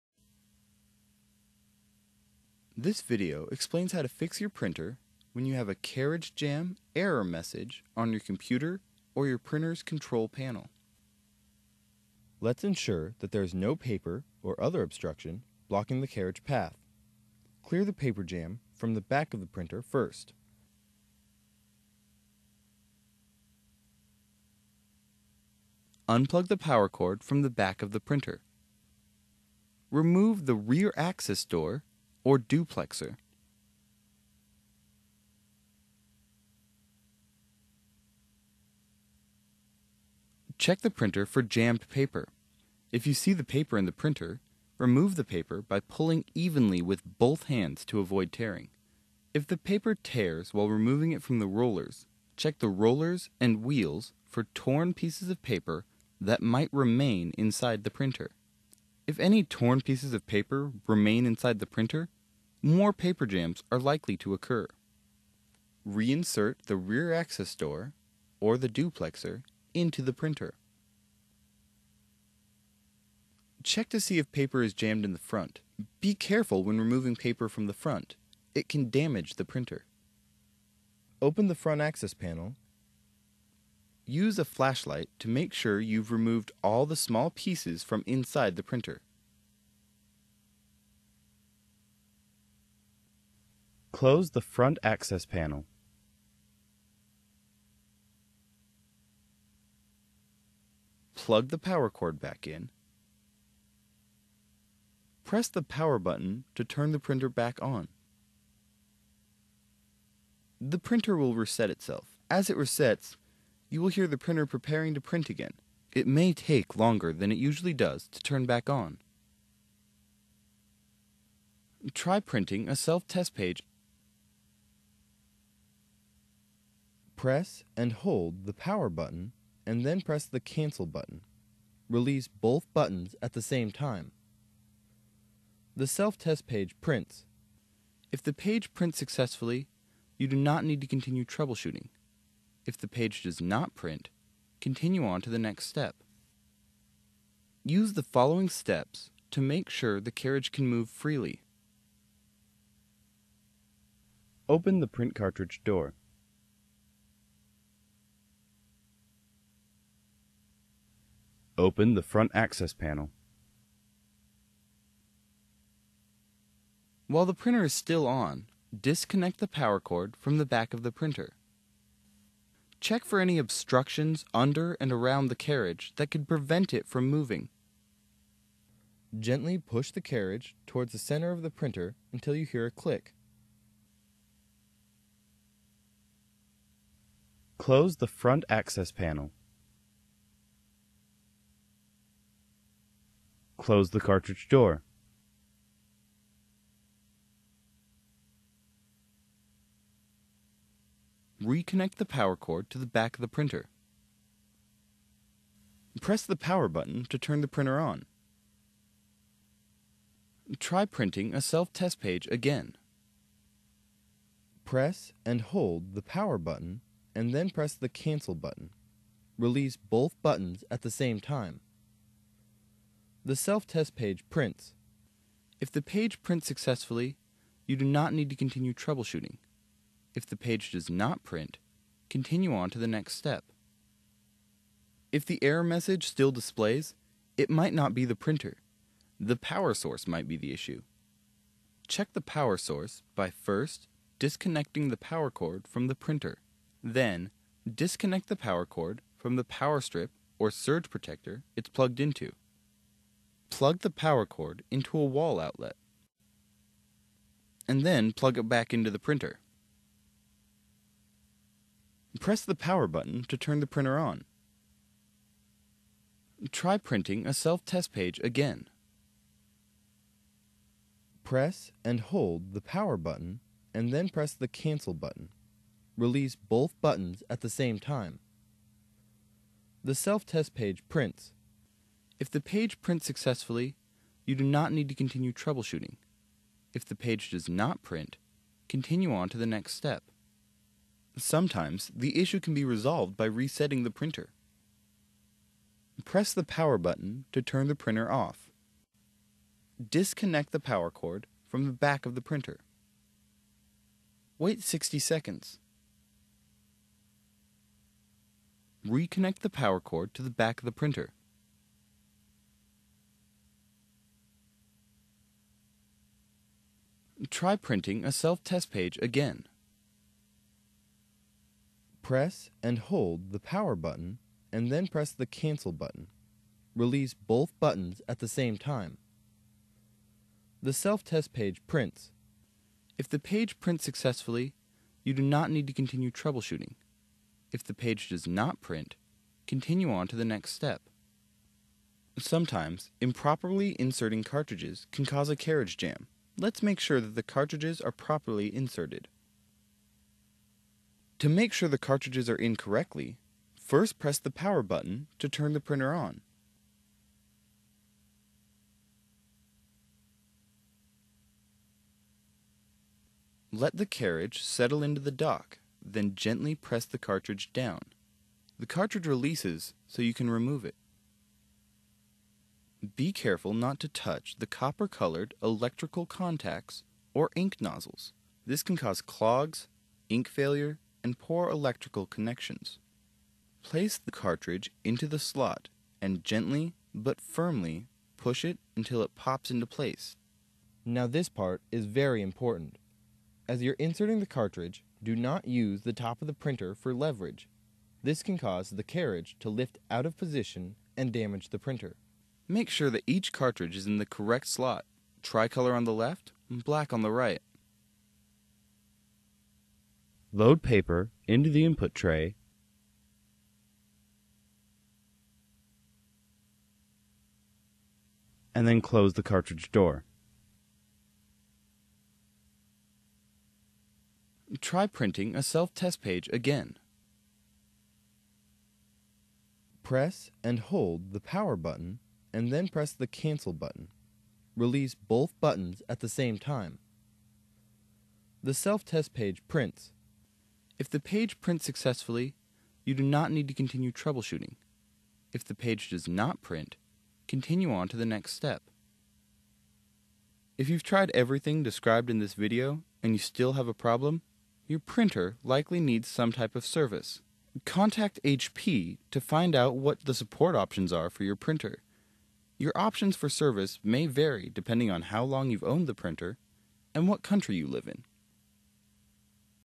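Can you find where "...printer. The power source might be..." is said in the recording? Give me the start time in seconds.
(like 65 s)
238 s.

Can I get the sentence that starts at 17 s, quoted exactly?
Clear the paper jam from the back of the printer first.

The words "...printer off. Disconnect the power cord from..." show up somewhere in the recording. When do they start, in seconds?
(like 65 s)
297 s.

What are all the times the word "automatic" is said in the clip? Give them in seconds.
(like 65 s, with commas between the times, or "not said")
not said.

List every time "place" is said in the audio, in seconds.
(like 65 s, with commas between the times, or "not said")
383 s, 389 s.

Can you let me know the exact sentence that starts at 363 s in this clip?
Let the carriage settle into the dock, then gently press the cartridge down.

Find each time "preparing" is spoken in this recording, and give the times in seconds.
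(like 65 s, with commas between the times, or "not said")
114 s.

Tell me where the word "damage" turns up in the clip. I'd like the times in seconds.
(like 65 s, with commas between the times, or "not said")
78 s, 401 s.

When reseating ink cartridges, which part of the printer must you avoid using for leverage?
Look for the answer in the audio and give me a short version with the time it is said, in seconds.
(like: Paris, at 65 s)
The top of the printer, at 395 s.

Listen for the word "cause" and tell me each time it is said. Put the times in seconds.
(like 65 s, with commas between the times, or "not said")
345 s, 378 s, 398 s.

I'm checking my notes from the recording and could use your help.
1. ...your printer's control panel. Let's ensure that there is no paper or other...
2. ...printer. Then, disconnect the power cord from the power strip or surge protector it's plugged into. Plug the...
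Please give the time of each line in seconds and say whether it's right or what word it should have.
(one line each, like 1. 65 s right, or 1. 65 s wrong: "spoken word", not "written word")
1. 9 s right
2. 245 s right.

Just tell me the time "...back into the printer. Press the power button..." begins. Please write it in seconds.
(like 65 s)
258 s.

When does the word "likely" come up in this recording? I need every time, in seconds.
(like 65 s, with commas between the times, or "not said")
63 s, 455 s.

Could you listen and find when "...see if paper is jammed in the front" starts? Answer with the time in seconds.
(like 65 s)
73 s.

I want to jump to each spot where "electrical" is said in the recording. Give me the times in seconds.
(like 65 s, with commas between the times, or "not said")
375 s, 381 s.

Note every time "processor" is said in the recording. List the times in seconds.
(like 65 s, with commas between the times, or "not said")
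not said.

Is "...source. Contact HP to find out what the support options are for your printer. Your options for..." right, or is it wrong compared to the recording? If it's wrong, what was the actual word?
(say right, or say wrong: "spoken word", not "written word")
wrong: "service", not "source".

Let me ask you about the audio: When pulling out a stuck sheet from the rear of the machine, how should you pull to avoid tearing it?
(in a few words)
evenly with both hands.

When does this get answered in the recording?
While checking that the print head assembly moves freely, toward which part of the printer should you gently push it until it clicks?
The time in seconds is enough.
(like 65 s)
180 s.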